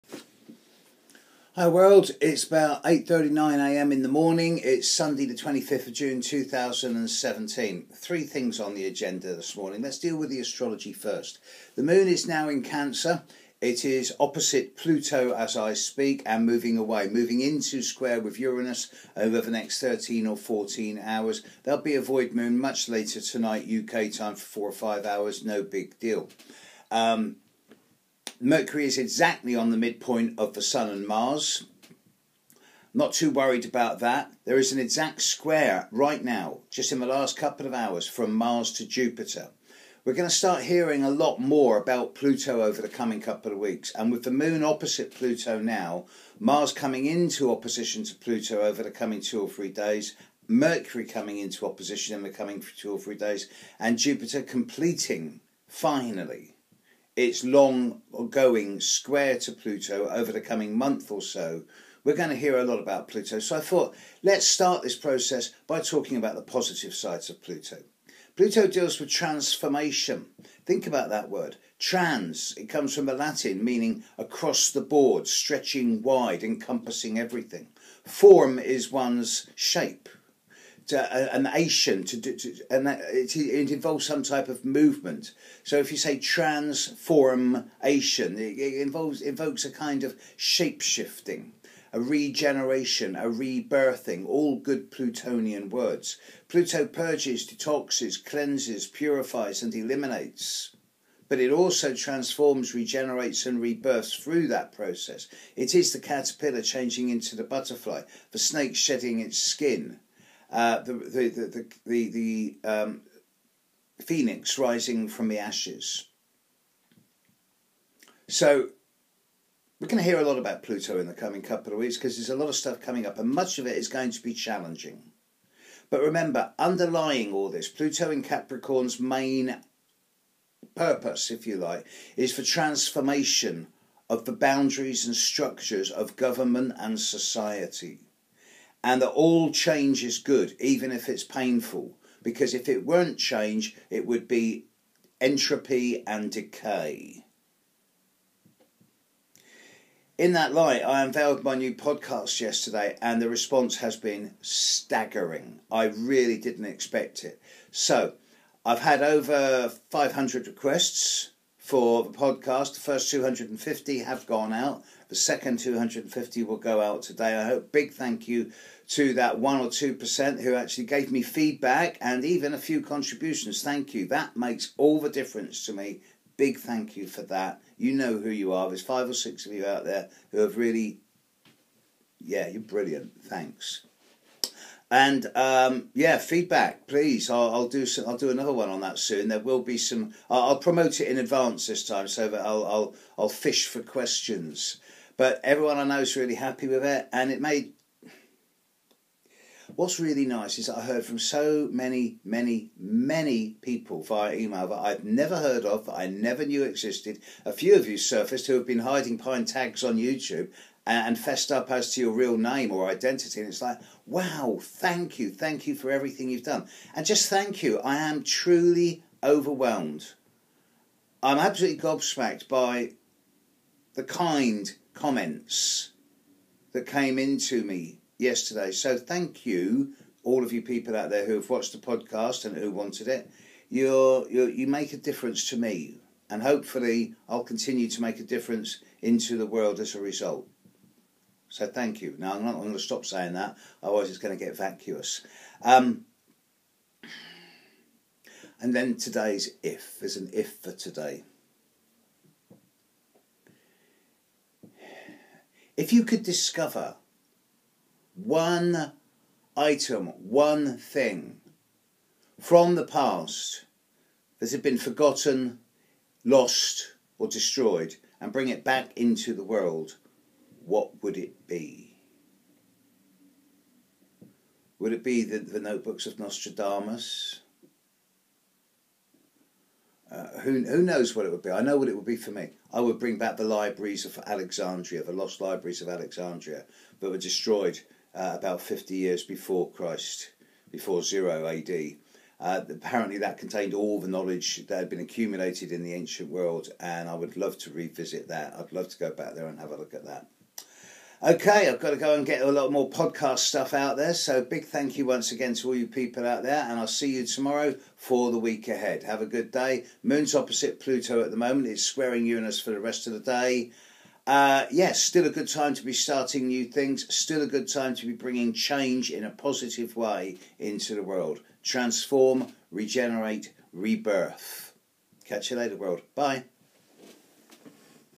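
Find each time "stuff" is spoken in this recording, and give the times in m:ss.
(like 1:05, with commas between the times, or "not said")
2:02, 5:03.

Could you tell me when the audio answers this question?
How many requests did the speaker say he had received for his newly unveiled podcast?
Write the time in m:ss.
2:39.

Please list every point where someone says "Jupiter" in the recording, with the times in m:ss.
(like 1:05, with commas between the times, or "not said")
0:38, 0:53.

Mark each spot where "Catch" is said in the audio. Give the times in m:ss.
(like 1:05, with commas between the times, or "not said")
5:25.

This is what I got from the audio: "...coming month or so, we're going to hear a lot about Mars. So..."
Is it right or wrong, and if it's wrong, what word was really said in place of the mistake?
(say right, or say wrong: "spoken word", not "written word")
wrong: "Pluto", not "Mars".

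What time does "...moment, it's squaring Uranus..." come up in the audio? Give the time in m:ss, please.
5:11.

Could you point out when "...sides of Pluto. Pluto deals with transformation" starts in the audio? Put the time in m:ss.
1:06.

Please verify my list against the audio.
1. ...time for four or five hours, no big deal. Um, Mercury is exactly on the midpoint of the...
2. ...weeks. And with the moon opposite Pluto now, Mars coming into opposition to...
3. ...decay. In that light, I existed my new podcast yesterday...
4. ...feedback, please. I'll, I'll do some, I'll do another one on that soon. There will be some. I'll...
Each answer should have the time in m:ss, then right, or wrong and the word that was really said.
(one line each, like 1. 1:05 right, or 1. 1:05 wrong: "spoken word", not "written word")
1. 0:24 right
2. 0:43 right
3. 2:26 wrong: "unveiled", not "existed"
4. 3:06 right.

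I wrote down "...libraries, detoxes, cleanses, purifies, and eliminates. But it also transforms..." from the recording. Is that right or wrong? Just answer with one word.
wrong.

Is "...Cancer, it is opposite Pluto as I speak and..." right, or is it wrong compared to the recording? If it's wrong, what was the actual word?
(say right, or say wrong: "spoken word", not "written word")
right.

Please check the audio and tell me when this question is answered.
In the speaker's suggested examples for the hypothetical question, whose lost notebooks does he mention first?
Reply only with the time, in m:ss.
4:36.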